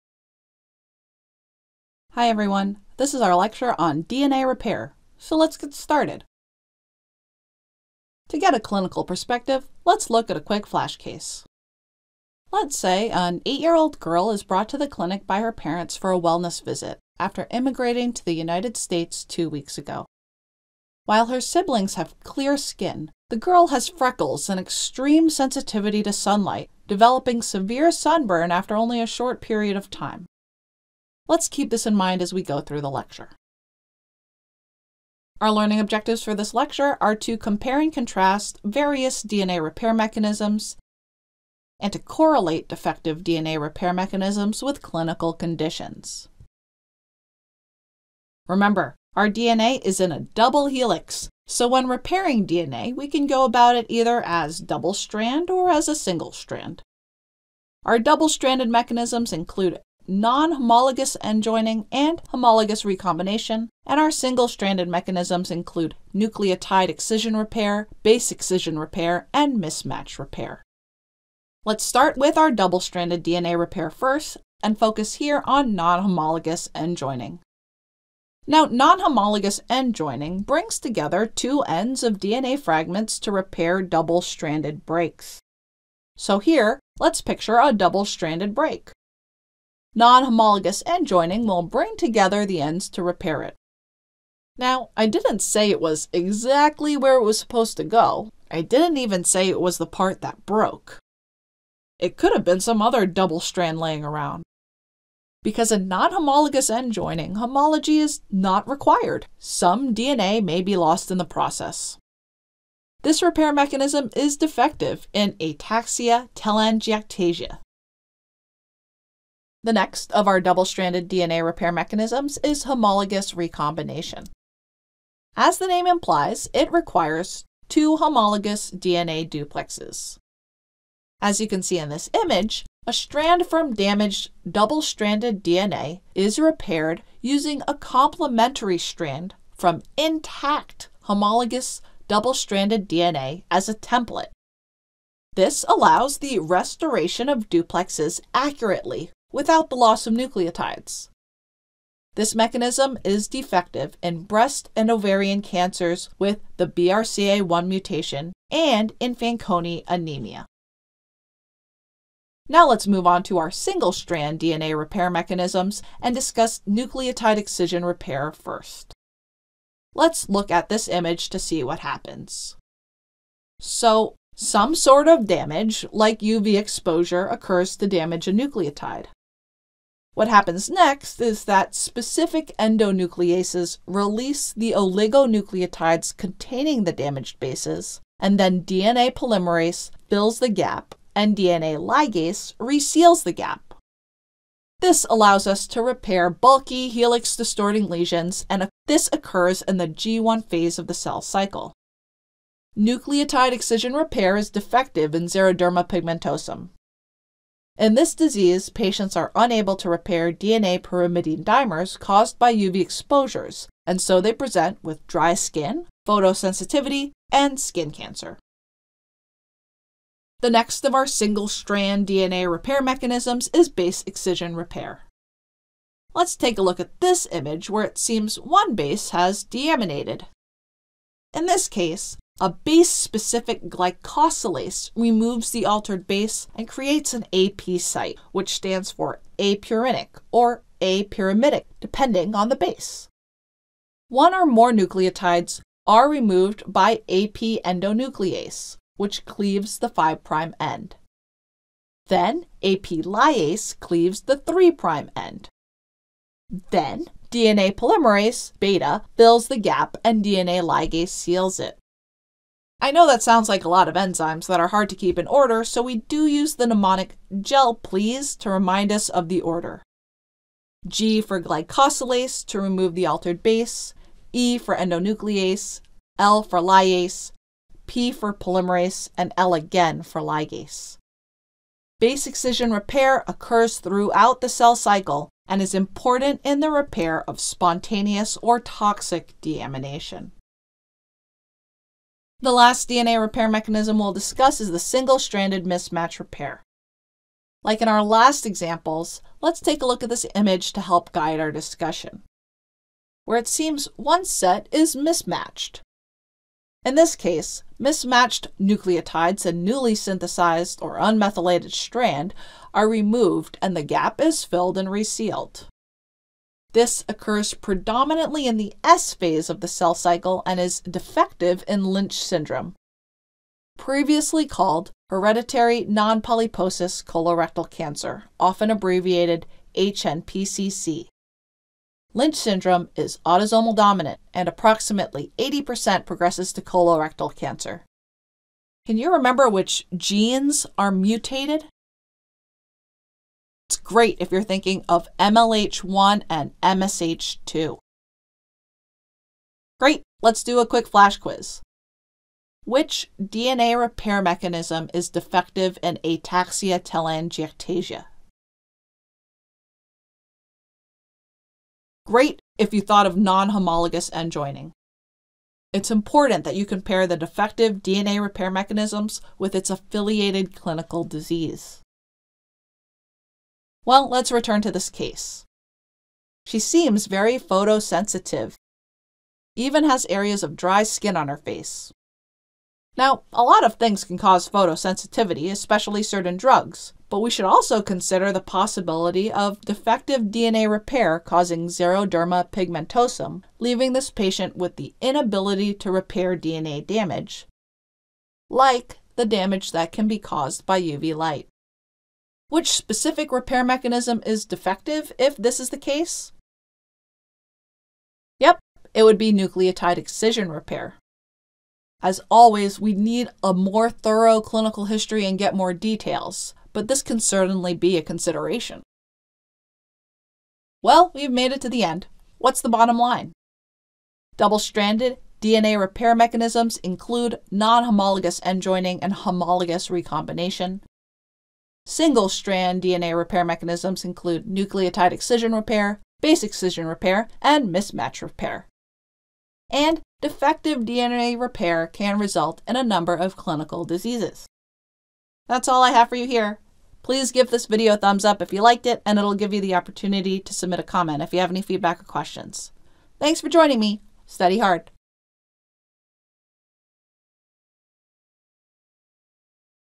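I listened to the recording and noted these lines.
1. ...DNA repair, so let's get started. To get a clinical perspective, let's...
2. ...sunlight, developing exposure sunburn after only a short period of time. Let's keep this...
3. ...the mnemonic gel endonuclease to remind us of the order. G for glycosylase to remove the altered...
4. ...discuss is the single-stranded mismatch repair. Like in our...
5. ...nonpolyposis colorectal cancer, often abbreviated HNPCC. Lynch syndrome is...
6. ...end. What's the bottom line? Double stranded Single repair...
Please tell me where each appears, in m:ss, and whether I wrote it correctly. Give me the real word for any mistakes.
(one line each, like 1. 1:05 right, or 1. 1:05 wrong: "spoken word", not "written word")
1. 0:04 right
2. 0:26 wrong: "severe", not "exposure"
3. 4:26 wrong: "please", not "endonuclease"
4. 4:54 right
5. 5:25 right
6. 7:01 wrong: "DNA", not "Single".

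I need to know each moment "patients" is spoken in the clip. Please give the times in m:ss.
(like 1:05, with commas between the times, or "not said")
3:28, 6:34.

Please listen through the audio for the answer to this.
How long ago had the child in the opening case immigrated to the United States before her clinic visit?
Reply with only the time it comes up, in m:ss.
0:19.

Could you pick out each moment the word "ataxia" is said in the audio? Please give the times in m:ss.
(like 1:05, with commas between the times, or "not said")
1:55, 5:56.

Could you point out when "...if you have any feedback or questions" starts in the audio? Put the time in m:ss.
7:31.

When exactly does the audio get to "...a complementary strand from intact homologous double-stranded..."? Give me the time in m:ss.
2:17.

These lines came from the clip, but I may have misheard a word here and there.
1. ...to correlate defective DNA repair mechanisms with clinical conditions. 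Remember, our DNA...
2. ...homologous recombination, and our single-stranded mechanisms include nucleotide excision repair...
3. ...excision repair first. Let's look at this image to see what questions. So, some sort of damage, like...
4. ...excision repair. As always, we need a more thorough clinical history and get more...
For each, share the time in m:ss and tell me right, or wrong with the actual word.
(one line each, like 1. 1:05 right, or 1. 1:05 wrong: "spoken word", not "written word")
1. 0:41 right
2. 1:02 right
3. 2:47 wrong: "happens", not "questions"
4. 6:49 right.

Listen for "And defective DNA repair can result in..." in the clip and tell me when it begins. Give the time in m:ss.
7:19.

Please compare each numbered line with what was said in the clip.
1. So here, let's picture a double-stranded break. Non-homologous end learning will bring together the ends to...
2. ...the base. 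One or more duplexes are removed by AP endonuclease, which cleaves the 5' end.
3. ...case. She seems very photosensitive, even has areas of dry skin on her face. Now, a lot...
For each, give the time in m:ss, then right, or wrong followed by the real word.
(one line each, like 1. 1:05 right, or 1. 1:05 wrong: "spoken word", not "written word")
1. 1:26 wrong: "joining", not "learning"
2. 4:02 wrong: "nucleotides", not "duplexes"
3. 6:14 right.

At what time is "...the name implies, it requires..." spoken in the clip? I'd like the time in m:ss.
2:05.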